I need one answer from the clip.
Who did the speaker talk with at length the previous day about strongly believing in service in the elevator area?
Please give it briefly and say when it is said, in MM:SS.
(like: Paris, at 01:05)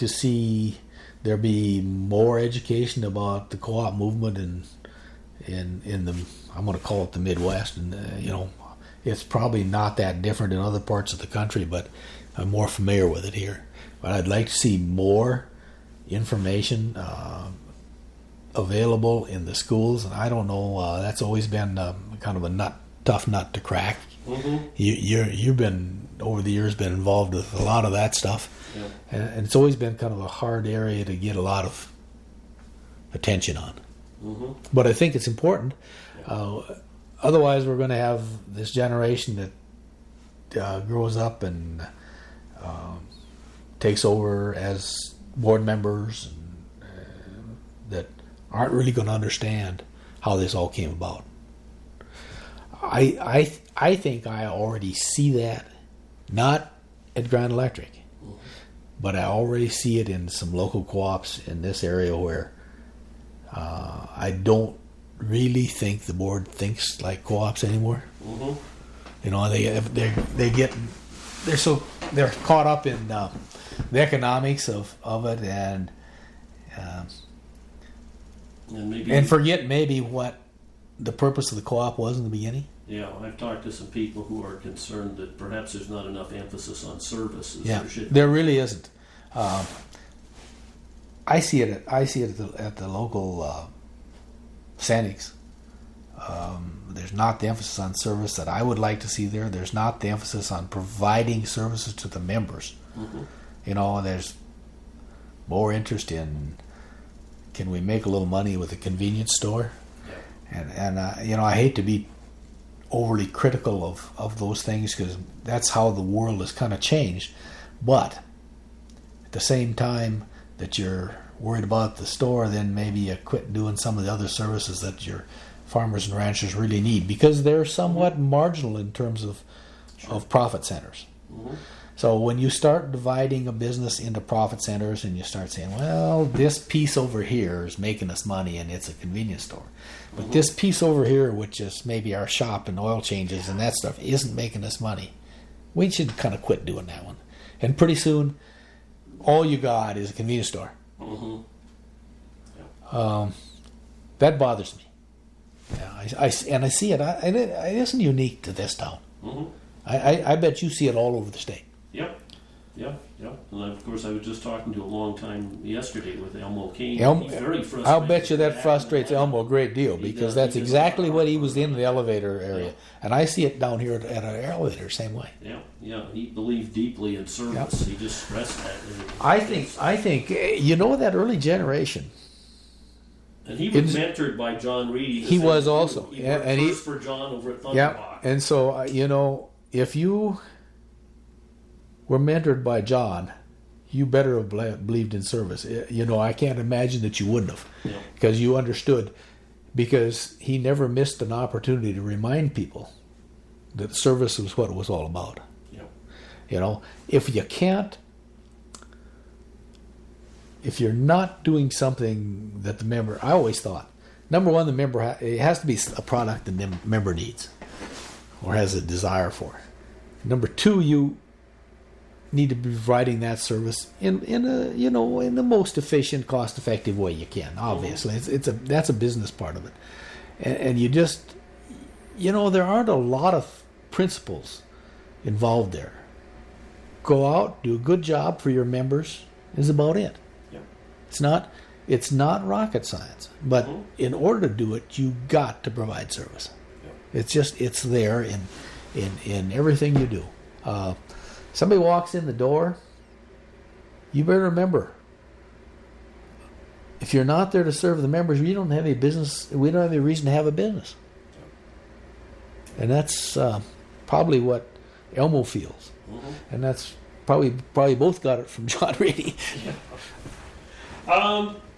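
Elmo Kane, at 02:46.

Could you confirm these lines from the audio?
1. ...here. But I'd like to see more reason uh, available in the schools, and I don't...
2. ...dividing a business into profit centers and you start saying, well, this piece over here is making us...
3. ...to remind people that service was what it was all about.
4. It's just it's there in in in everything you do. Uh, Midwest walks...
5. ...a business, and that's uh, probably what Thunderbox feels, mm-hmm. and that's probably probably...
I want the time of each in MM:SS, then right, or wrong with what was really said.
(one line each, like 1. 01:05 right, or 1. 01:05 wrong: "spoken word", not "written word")
1. 00:13 wrong: "information", not "reason"
2. 02:12 right
3. 03:21 right
4. 04:07 wrong: "Somebody", not "Midwest"
5. 04:20 wrong: "Elmo", not "Thunderbox".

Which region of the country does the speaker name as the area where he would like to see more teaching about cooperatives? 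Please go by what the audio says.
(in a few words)
Midwest.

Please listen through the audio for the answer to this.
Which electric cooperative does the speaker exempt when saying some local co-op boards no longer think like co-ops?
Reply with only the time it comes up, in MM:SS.
00:57.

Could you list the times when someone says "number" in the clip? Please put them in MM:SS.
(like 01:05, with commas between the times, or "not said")
03:34, 03:40.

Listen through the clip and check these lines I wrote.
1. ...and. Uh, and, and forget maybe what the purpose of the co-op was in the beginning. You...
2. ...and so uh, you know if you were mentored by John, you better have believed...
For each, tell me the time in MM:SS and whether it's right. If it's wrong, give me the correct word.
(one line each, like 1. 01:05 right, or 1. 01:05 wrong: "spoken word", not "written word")
1. 01:15 right
2. 03:08 right.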